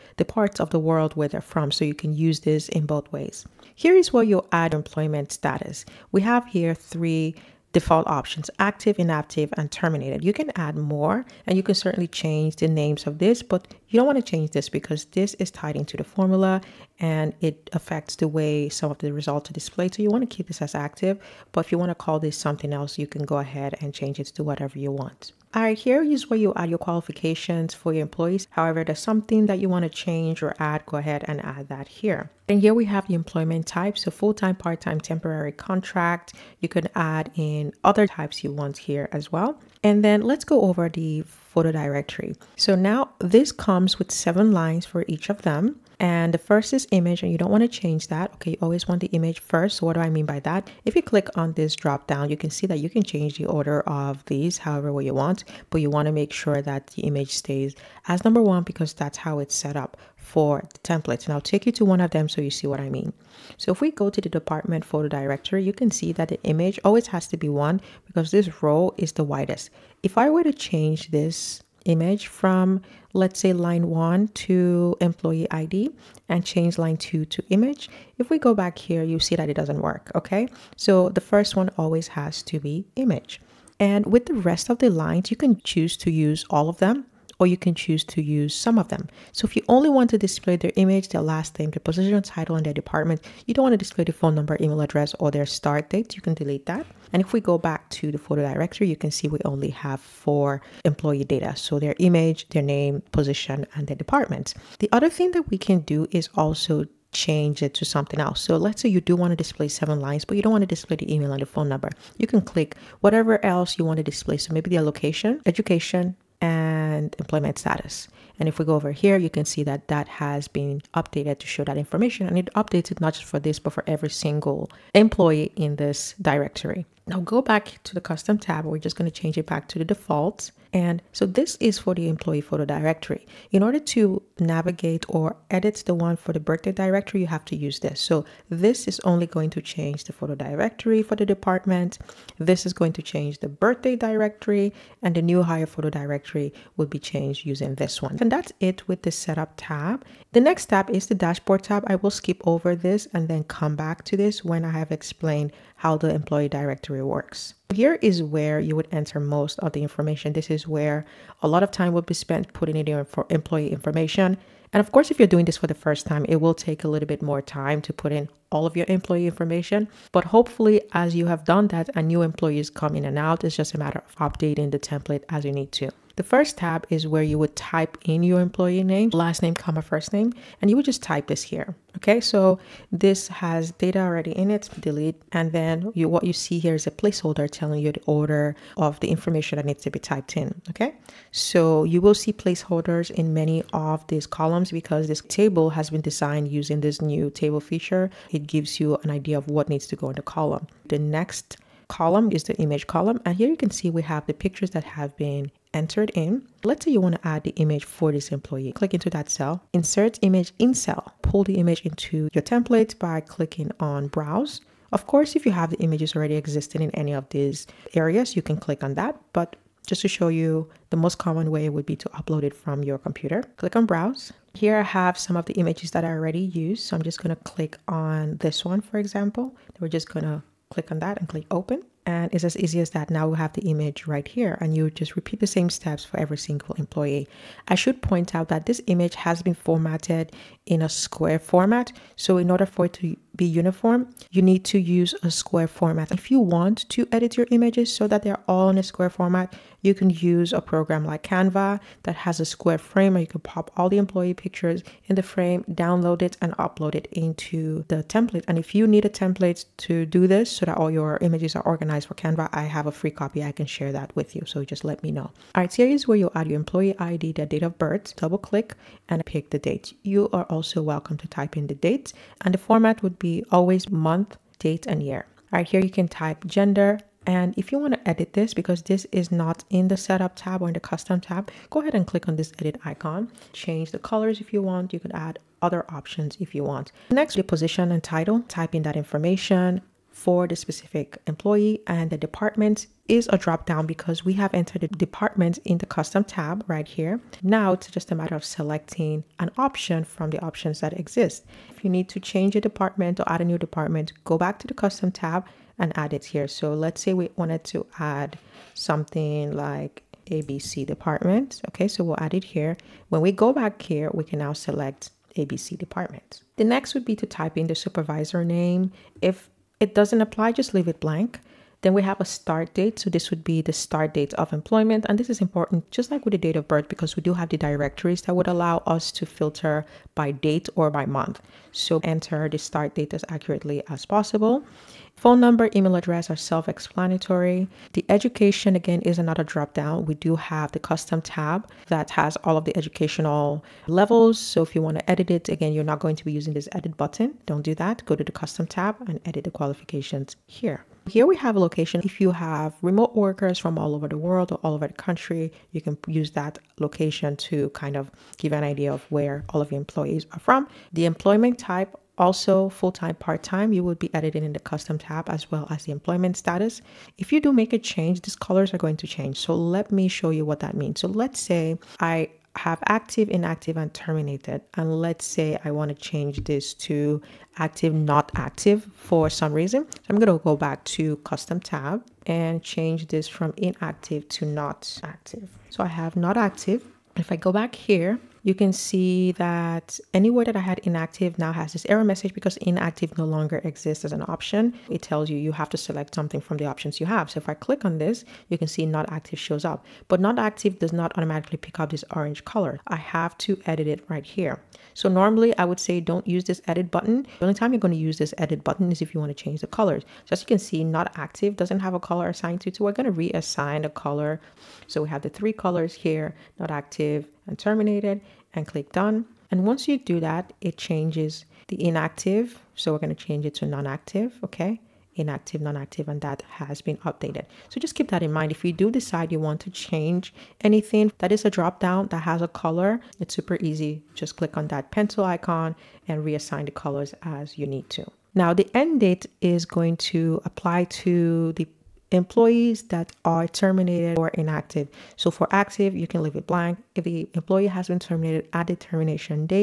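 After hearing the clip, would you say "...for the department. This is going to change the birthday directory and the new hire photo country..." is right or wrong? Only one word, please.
wrong.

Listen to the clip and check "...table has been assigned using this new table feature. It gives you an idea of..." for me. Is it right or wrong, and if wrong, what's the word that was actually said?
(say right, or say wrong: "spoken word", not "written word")
wrong: "designed", not "assigned".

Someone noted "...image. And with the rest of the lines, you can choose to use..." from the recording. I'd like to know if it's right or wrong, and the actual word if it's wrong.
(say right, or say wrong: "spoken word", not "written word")
right.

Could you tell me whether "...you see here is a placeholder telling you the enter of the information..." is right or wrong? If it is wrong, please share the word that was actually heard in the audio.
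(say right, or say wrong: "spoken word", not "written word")
wrong: "order", not "enter".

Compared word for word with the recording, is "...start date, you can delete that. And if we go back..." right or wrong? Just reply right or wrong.
right.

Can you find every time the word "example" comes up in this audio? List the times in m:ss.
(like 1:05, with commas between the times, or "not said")
3:48.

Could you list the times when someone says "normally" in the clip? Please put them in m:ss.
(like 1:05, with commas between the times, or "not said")
6:45.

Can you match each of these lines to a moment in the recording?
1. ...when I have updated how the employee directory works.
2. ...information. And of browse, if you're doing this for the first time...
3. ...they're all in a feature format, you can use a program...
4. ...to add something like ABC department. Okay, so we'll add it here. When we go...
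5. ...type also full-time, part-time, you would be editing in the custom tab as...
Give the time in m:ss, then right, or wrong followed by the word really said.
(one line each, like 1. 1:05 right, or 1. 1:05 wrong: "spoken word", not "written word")
1. 2:34 wrong: "explained", not "updated"
2. 2:43 wrong: "course", not "browse"
3. 4:08 wrong: "square", not "feature"
4. 5:07 right
5. 6:01 right.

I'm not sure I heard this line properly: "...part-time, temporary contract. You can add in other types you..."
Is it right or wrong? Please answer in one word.
right.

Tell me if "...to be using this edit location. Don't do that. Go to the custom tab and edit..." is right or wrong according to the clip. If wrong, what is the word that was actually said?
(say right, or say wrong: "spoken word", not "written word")
wrong: "button", not "location".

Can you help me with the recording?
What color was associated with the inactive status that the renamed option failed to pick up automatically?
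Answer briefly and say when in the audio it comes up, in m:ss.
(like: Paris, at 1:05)
Orange, at 6:42.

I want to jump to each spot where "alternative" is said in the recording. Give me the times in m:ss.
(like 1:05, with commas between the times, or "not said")
not said.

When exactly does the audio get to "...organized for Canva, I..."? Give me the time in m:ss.
4:21.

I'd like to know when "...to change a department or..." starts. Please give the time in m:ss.
5:02.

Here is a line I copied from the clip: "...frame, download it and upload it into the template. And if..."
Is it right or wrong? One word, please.
right.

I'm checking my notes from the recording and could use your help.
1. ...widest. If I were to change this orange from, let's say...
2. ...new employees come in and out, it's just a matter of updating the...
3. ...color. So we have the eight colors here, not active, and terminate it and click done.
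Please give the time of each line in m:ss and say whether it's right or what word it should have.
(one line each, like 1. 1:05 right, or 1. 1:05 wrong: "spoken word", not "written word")
1. 1:09 wrong: "image", not "orange"
2. 2:52 right
3. 6:53 wrong: "three", not "eight".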